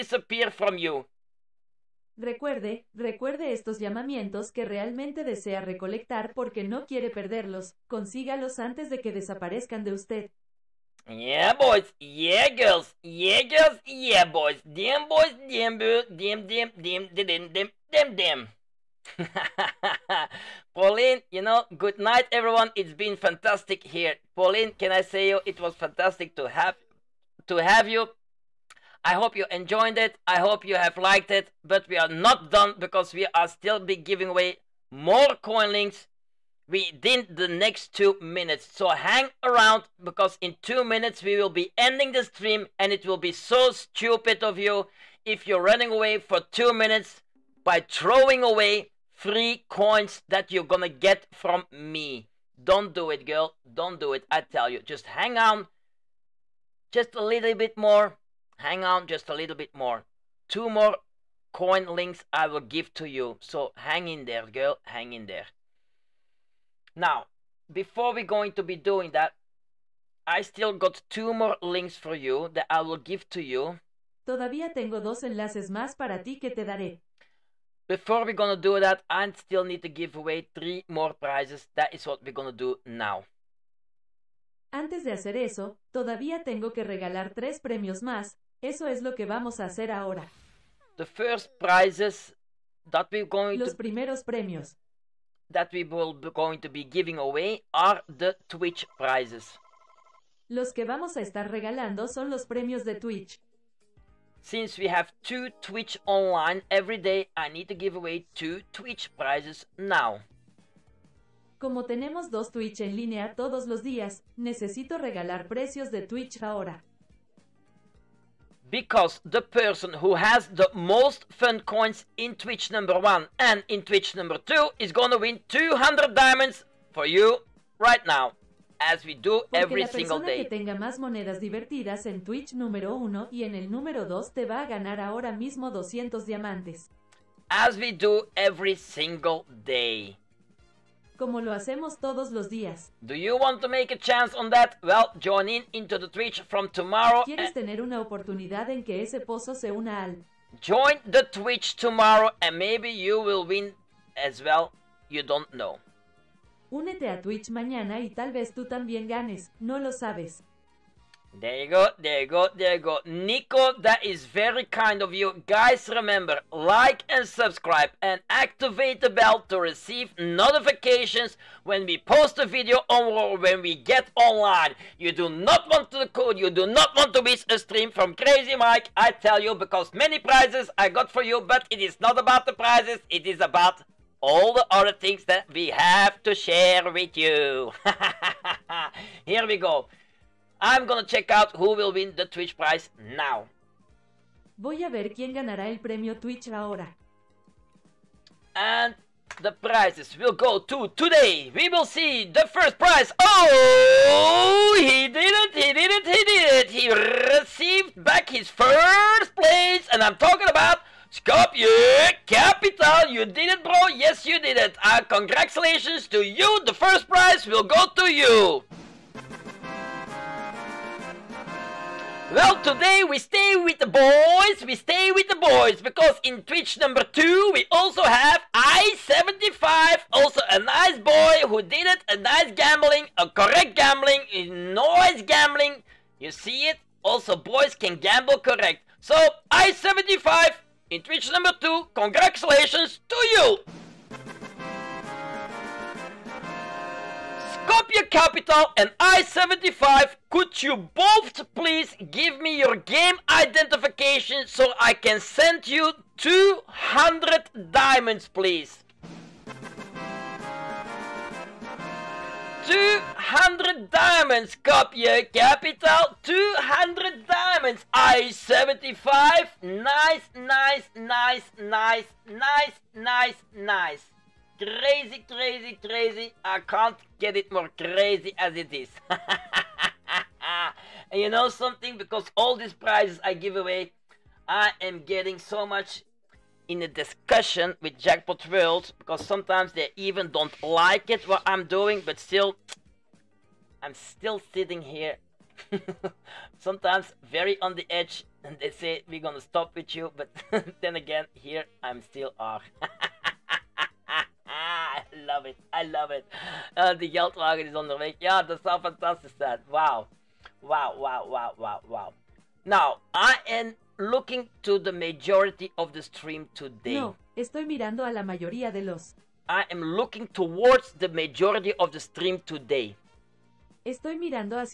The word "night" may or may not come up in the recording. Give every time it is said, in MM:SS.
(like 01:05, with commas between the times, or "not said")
00:21.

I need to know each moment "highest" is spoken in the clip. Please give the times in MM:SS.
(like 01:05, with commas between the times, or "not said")
not said.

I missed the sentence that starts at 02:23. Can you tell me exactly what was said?
Do you want to make a chance on that?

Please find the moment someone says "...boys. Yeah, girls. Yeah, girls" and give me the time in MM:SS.
00:11.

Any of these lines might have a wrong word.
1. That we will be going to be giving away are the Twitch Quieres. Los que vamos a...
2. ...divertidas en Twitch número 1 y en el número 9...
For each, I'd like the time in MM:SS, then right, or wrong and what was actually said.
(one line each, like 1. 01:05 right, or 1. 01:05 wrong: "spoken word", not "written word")
1. 01:35 wrong: "prizes", not "Quieres"
2. 02:11 wrong: "2", not "9".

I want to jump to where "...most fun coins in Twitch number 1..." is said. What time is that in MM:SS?
02:00.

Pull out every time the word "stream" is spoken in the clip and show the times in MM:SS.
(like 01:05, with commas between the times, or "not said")
00:42, 02:57.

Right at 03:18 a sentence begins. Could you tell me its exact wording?
And the prizes will go to today.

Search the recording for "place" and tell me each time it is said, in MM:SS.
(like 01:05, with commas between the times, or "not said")
03:29.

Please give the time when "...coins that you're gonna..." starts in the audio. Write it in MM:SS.
00:49.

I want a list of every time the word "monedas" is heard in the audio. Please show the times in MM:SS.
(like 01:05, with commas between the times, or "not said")
02:10.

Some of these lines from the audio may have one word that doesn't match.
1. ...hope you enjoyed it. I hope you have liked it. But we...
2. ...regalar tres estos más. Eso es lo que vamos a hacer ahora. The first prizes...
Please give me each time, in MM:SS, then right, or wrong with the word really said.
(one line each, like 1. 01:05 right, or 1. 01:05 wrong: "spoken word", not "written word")
1. 00:29 right
2. 01:26 wrong: "premios", not "estos".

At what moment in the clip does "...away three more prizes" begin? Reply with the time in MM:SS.
01:20.